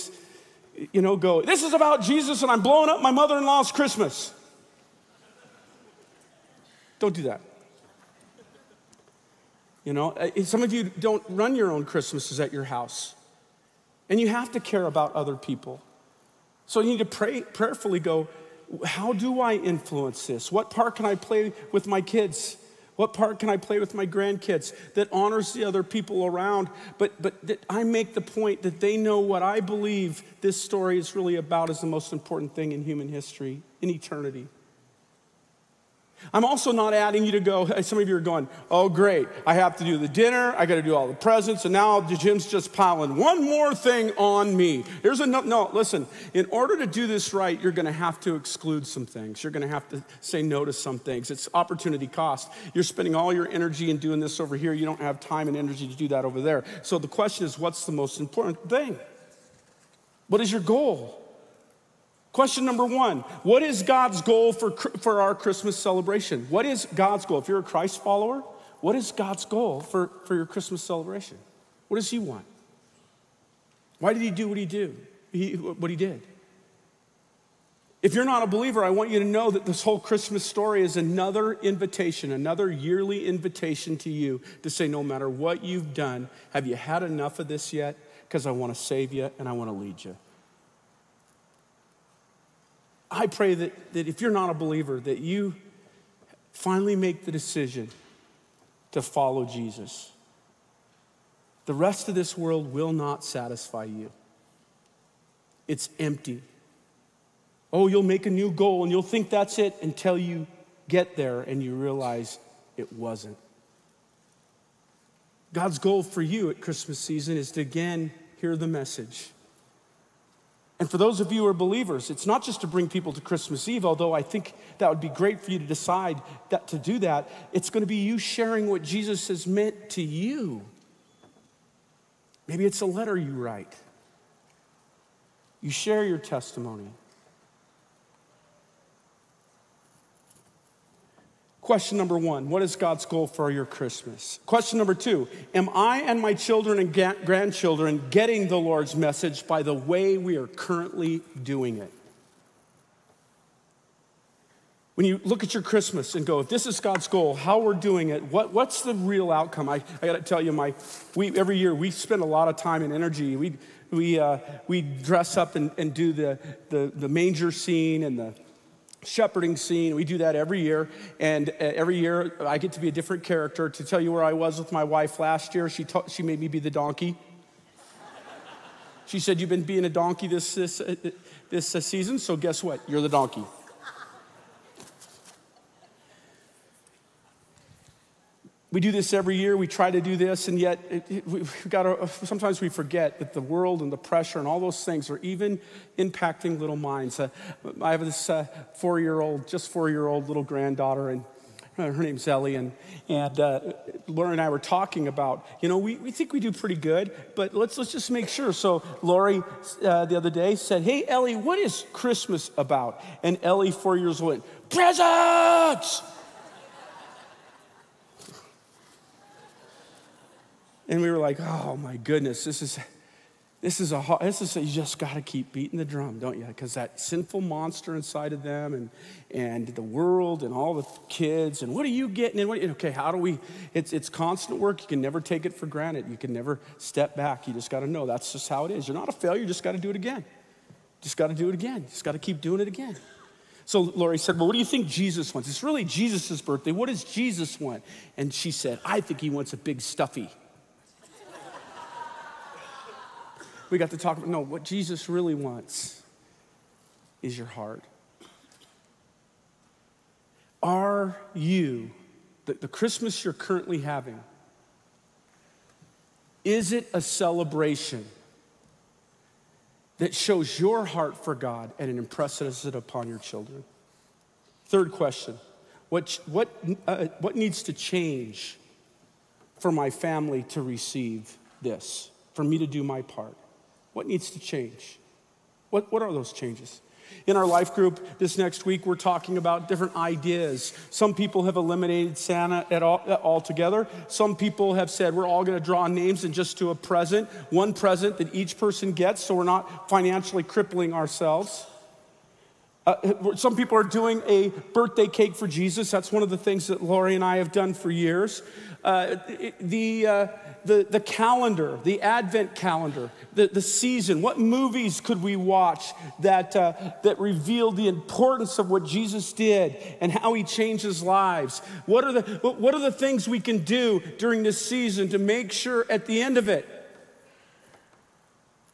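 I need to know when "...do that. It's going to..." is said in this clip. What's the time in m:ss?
2:06.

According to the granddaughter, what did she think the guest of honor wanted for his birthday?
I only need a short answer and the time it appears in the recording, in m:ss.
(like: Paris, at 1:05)
A big stuffy, at 4:09.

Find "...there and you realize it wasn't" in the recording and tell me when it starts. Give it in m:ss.
1:51.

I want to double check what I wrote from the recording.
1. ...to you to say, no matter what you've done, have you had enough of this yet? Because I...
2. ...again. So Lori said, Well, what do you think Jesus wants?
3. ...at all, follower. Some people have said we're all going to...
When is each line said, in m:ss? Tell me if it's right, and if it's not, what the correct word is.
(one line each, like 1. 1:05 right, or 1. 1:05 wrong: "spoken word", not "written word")
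1. 1:23 right
2. 4:02 right
3. 4:52 wrong: "altogether", not "follower".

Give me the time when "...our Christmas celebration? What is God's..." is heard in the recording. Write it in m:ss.
1:05.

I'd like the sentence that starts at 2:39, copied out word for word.
I, I gotta tell you, my, we, every year we spend a lot of time and energy.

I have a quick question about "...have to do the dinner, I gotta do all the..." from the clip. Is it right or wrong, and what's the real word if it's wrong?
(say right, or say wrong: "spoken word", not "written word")
right.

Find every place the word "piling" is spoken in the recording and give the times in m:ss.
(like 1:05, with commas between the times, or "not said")
0:42.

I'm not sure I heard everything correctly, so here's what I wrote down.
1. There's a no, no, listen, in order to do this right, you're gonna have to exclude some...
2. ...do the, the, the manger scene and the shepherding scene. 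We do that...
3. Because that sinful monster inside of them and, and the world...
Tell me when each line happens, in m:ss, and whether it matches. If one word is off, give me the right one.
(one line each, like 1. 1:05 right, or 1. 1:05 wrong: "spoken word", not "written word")
1. 0:45 right
2. 2:45 right
3. 3:46 right.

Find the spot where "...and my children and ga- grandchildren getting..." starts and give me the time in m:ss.
2:26.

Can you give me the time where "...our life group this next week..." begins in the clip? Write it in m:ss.
4:47.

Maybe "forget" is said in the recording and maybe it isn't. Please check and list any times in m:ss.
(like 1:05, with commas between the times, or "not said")
3:12.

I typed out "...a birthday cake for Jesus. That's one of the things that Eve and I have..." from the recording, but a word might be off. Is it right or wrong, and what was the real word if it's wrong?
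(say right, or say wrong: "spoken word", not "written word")
wrong: "Lori", not "Eve".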